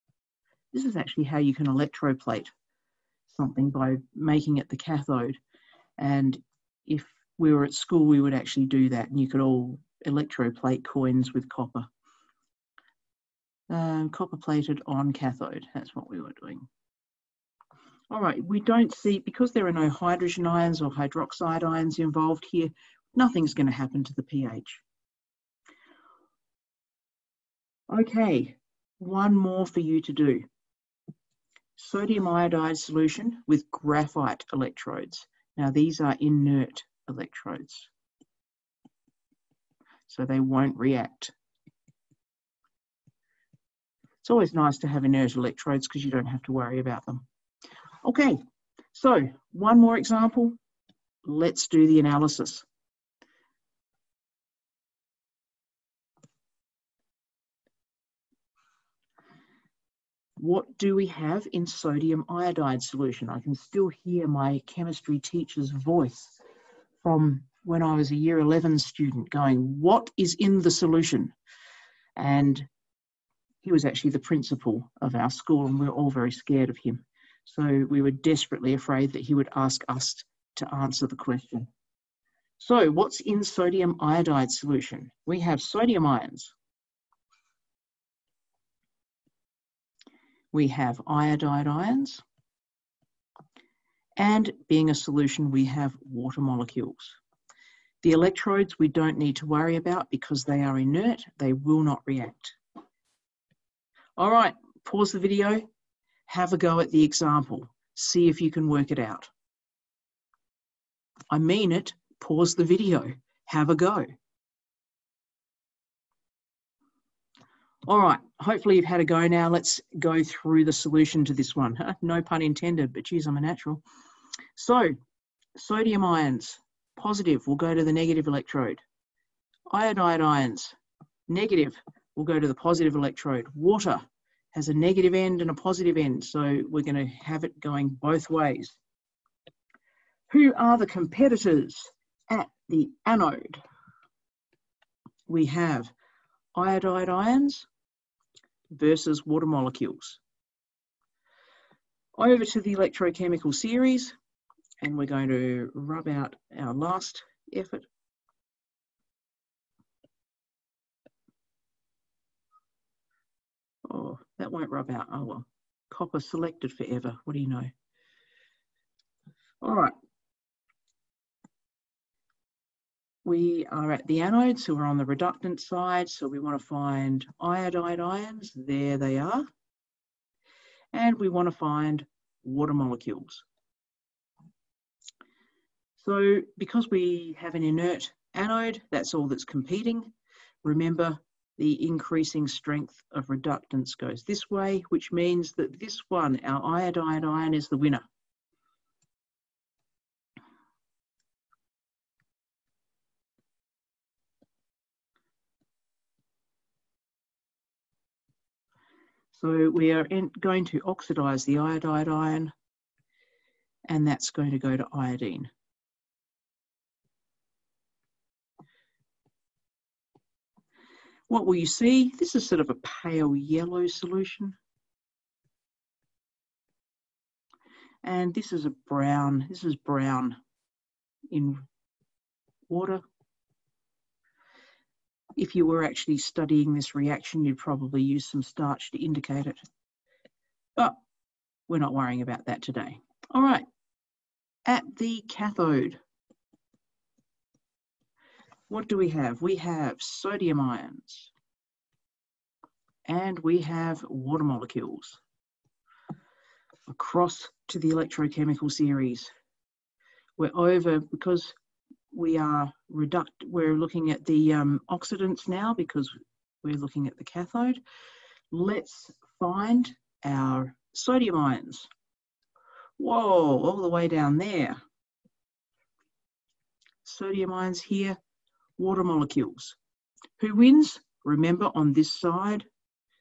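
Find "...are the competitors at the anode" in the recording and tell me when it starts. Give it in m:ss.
2:20.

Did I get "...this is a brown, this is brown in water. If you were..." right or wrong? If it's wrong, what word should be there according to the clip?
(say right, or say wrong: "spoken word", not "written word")
right.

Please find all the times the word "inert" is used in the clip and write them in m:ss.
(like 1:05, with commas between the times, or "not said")
0:36, 0:45, 1:40, 3:07.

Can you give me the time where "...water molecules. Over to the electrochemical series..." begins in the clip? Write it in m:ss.
2:29.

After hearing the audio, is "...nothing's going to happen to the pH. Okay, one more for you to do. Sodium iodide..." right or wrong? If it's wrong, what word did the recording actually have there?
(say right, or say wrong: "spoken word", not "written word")
right.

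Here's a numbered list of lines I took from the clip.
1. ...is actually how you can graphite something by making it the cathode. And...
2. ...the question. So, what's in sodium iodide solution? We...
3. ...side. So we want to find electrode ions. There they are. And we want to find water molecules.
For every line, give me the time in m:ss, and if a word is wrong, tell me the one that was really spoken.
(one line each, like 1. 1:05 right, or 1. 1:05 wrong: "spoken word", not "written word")
1. 0:00 wrong: "electroplate", not "graphite"
2. 1:21 right
3. 2:55 wrong: "iodide", not "electrode".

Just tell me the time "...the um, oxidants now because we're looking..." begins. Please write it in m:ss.
4:24.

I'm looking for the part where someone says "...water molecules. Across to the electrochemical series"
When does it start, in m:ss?
4:14.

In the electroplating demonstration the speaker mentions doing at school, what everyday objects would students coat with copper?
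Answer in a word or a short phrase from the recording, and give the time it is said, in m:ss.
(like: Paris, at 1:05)
Coins, at 0:10.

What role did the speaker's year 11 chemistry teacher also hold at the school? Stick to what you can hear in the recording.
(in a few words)
Principal.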